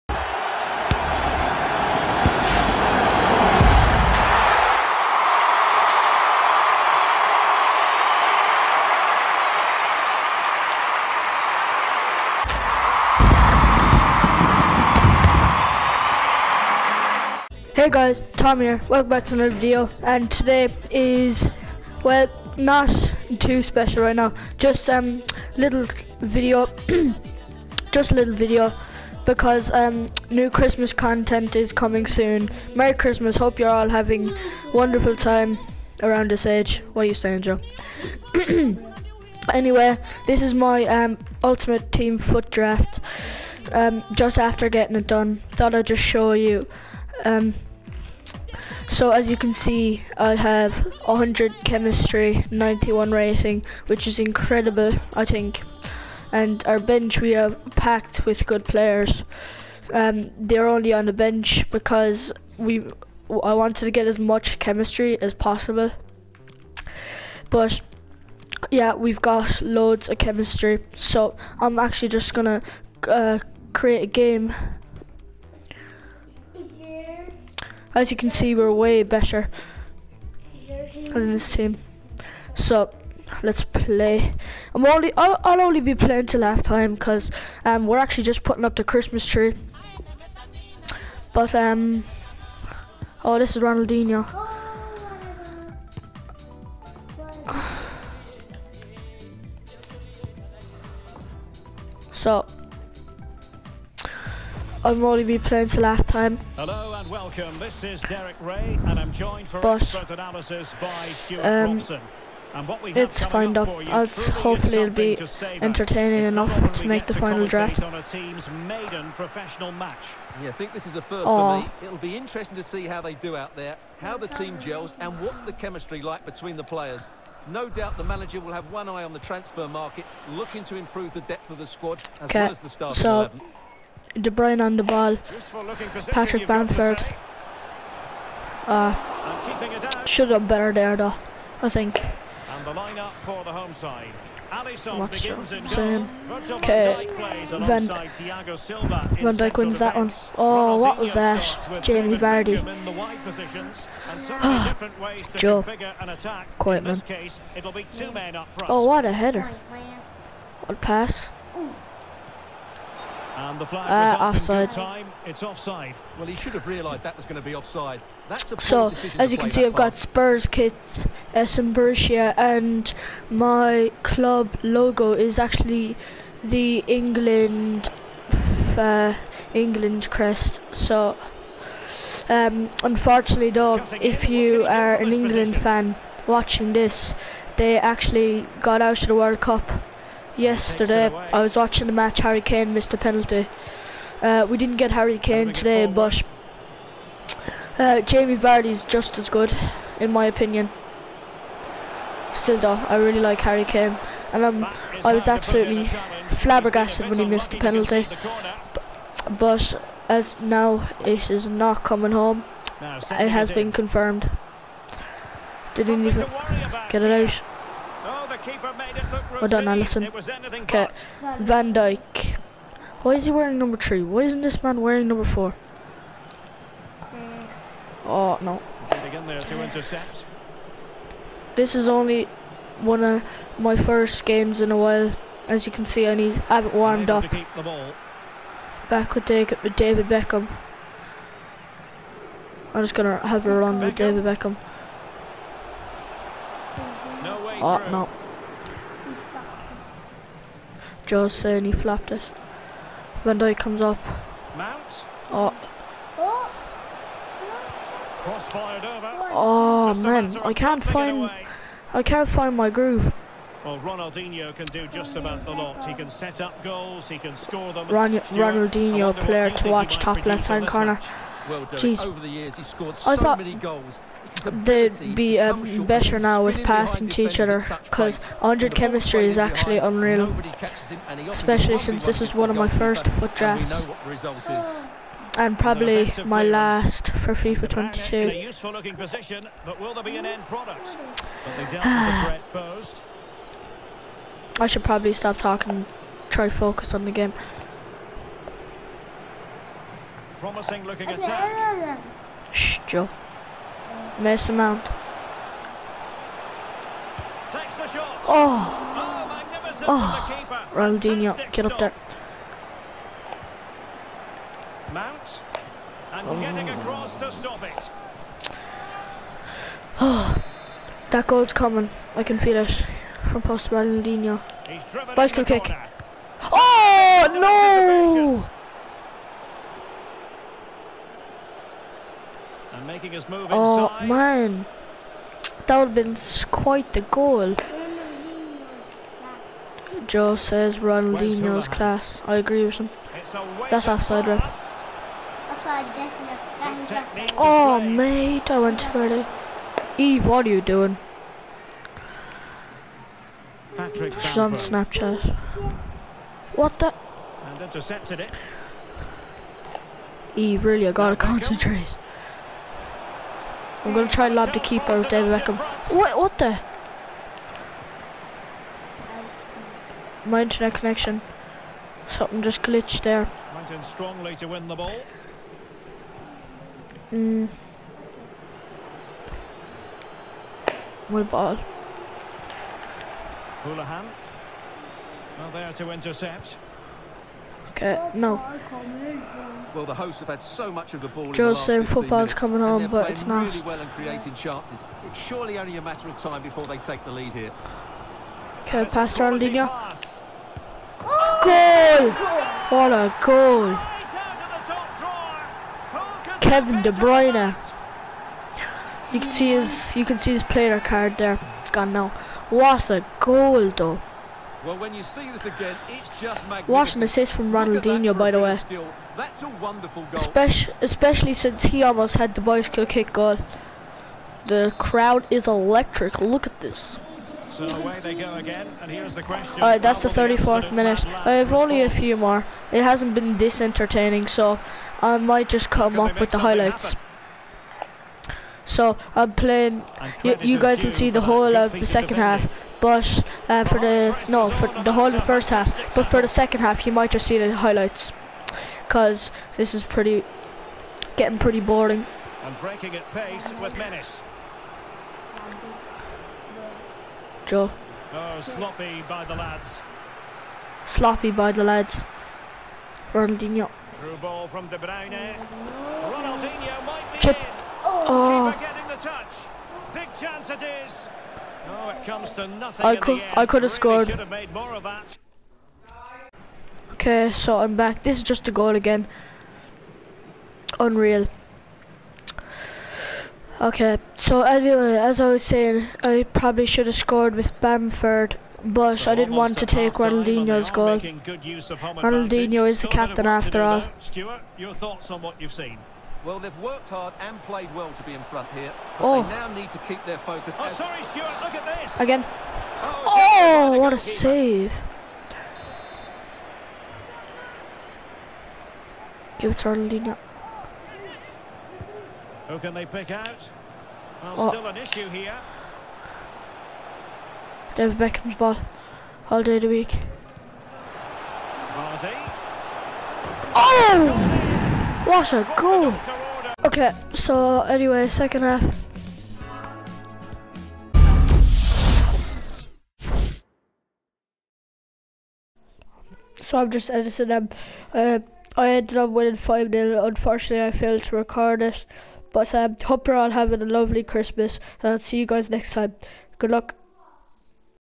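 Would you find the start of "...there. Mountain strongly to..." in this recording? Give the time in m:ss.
6:13.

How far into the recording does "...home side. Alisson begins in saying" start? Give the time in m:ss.
2:23.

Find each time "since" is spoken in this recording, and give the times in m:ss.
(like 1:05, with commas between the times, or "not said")
4:41, 7:01.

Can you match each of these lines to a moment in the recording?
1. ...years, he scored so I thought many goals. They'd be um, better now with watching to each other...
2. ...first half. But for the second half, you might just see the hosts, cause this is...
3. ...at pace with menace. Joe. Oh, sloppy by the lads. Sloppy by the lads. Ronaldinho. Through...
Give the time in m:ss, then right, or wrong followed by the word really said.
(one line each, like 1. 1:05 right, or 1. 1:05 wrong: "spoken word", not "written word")
1. 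4:32 wrong: "passing", not "watching"
2. 7:25 wrong: "highlights", not "hosts"
3. 7:32 right.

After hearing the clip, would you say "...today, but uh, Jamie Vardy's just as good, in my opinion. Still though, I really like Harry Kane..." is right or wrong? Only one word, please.
right.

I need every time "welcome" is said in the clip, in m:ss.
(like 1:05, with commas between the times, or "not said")
0:18, 1:47.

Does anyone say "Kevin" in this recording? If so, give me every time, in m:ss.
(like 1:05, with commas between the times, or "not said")
6:46.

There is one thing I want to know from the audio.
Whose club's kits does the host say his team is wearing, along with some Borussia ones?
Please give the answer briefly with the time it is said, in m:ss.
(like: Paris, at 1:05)
Spurs, at 2:49.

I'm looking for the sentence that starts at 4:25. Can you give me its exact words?
He can set up goals, he can score them.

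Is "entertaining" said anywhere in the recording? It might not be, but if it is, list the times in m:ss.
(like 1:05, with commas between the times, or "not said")
1:55, 7:13.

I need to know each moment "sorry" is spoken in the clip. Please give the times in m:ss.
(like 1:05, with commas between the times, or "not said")
8:20.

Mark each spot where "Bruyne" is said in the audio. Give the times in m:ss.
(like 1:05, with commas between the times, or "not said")
2:14, 6:46, 7:44.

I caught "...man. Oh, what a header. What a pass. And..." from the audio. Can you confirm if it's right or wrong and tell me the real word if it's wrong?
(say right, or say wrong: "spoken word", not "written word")
right.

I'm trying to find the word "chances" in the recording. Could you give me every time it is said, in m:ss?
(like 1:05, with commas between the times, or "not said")
6:34, 7:50.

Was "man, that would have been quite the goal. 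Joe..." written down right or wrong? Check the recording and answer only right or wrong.
right.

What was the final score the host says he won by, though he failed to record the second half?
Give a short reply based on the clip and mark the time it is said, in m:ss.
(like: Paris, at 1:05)
5-0, at 8:59.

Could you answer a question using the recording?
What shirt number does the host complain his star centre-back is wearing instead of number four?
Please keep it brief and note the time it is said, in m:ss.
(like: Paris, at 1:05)
3, at 3:43.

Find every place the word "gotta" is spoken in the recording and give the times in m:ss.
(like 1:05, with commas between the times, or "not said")
6:00.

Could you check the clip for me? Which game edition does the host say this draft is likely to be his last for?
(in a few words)
FIFA 22.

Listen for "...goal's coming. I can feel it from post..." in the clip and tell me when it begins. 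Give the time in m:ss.
5:21.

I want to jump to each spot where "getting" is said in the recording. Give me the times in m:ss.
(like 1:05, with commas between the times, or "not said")
0:44, 5:16, 7:31, 7:48.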